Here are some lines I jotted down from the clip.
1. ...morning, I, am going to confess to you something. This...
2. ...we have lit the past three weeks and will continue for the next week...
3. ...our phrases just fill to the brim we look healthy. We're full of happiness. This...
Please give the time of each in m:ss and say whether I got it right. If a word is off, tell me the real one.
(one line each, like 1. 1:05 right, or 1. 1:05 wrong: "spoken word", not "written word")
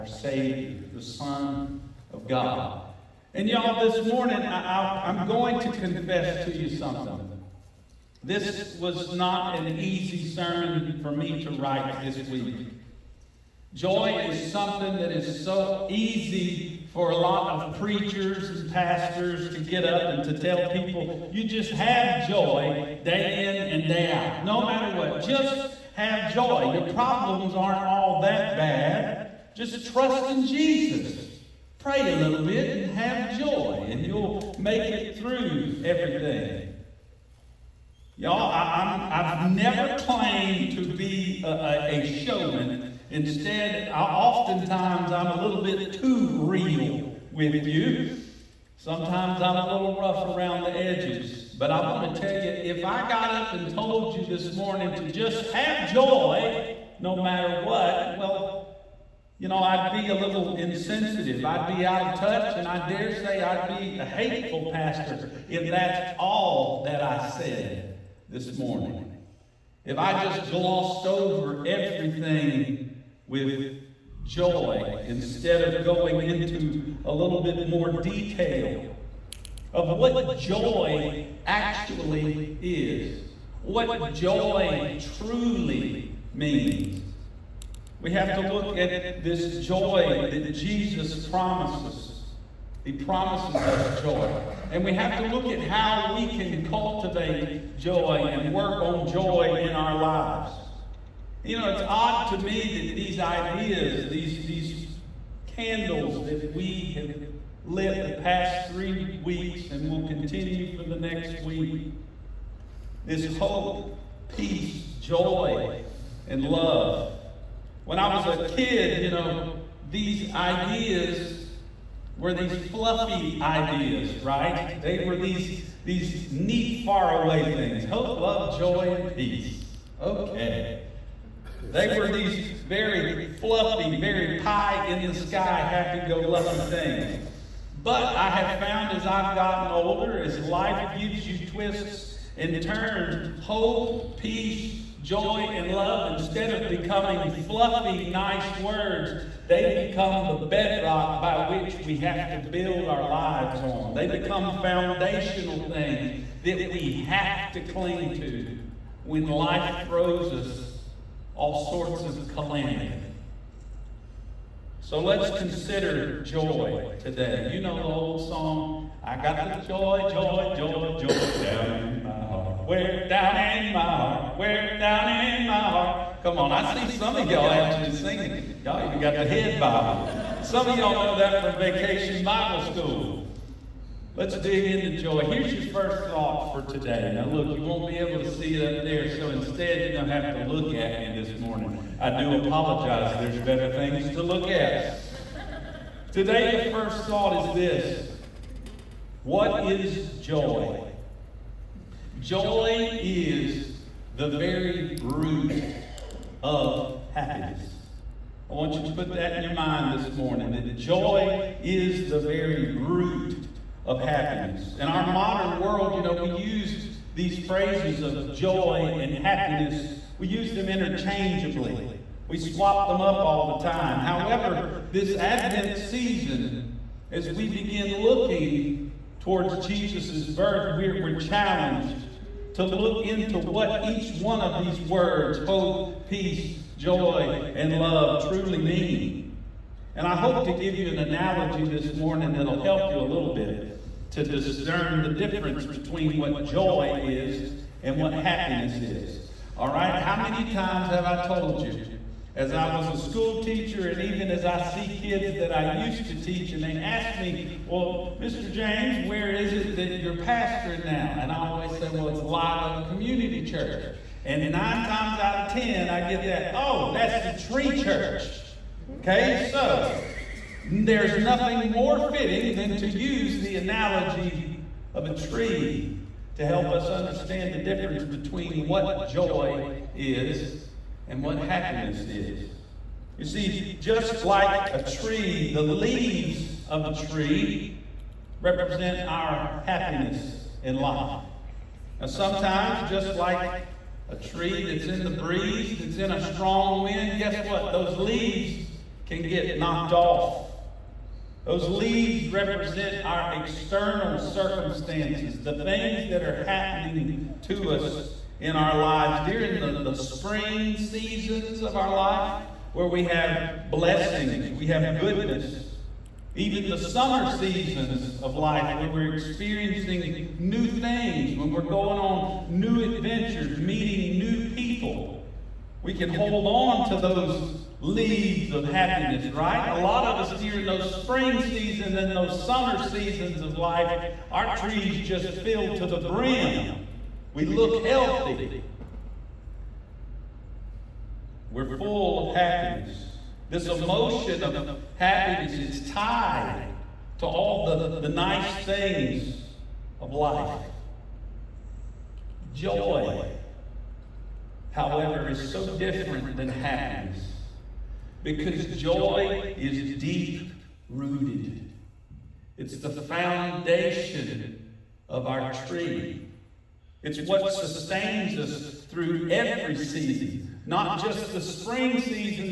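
1. 0:04 right
2. 1:46 right
3. 5:34 wrong: "trees", not "phrases".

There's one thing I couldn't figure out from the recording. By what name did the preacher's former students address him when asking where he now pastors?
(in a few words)
Mr. James.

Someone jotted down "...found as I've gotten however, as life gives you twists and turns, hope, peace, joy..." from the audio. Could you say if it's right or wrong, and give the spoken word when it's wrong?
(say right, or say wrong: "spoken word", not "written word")
wrong: "older", not "however".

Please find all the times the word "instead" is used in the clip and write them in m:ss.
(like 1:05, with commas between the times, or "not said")
0:43, 1:15, 2:26, 3:09.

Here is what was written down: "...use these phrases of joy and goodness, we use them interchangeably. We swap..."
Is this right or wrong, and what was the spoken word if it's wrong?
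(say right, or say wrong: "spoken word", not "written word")
wrong: "happiness", not "goodness".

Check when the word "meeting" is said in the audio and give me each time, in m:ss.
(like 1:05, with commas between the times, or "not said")
5:23.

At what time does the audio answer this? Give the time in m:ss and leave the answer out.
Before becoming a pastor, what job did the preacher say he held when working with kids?
4:12.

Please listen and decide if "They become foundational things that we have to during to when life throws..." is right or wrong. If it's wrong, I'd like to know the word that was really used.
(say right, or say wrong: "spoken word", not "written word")
wrong: "cling", not "during".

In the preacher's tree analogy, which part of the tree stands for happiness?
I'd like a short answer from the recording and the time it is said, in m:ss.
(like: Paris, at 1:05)
the leaves, at 4:45.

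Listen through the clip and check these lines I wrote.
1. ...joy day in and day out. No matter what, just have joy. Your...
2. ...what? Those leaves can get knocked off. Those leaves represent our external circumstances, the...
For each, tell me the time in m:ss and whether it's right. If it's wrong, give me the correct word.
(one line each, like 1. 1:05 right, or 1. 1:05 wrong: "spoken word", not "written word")
1. 0:22 right
2. 4:57 right.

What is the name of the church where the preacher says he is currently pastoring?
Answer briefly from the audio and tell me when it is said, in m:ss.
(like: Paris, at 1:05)
Live Oak Community Church, at 4:22.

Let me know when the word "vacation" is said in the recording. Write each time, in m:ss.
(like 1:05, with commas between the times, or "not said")
3:01.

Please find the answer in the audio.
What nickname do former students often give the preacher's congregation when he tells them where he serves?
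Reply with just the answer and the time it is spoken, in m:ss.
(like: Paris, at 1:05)
the tree church, at 4:27.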